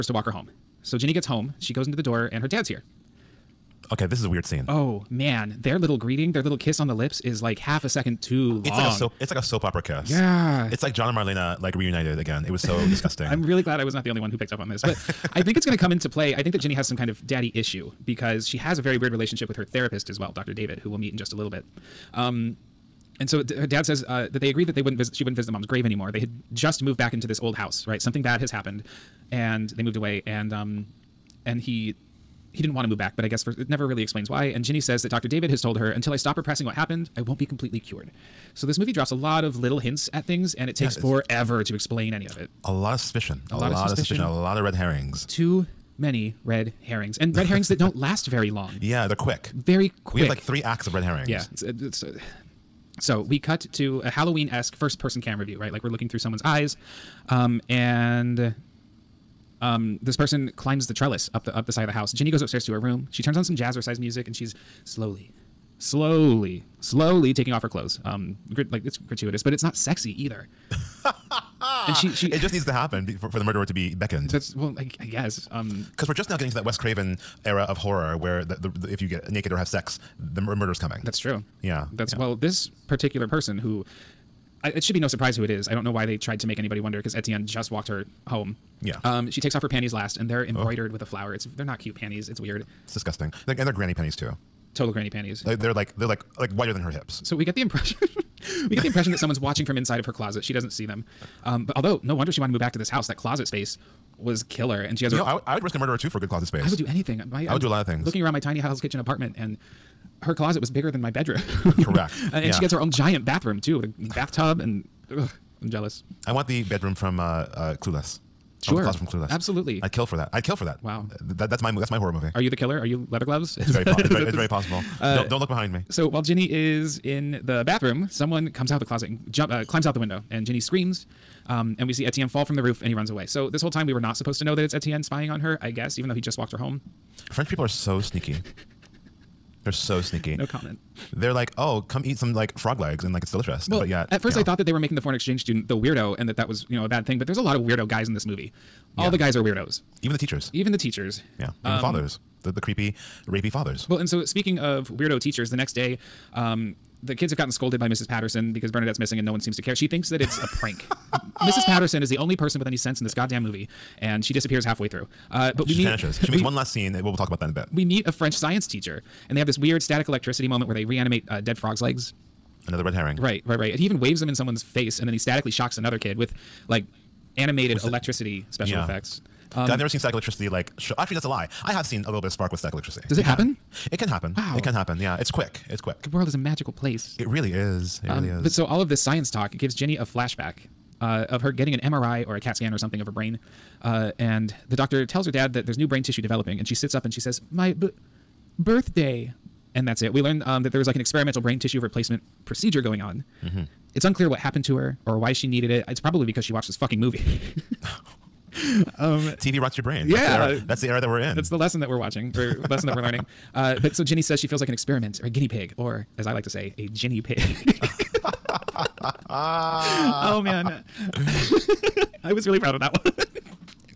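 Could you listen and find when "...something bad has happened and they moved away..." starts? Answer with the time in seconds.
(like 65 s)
27 s.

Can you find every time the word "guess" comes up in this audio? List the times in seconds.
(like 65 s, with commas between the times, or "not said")
33 s, 75 s, 135 s.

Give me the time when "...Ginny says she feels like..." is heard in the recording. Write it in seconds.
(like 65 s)
214 s.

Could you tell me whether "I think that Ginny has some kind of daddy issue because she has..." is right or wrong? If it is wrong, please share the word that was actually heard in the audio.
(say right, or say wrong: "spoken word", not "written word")
right.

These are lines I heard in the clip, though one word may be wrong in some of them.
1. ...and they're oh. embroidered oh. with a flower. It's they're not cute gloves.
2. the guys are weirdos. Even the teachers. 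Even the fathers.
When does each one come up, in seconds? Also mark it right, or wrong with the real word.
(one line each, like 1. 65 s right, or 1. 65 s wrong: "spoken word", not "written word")
1. 90 s wrong: "panties", not "gloves"
2. 149 s wrong: "teachers", not "fathers".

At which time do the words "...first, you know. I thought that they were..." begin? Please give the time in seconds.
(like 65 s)
144 s.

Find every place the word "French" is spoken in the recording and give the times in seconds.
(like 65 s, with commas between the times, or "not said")
137 s, 168 s.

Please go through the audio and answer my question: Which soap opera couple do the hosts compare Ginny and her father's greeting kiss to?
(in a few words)
John and Marlena.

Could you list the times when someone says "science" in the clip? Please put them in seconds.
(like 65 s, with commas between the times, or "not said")
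168 s, 188 s.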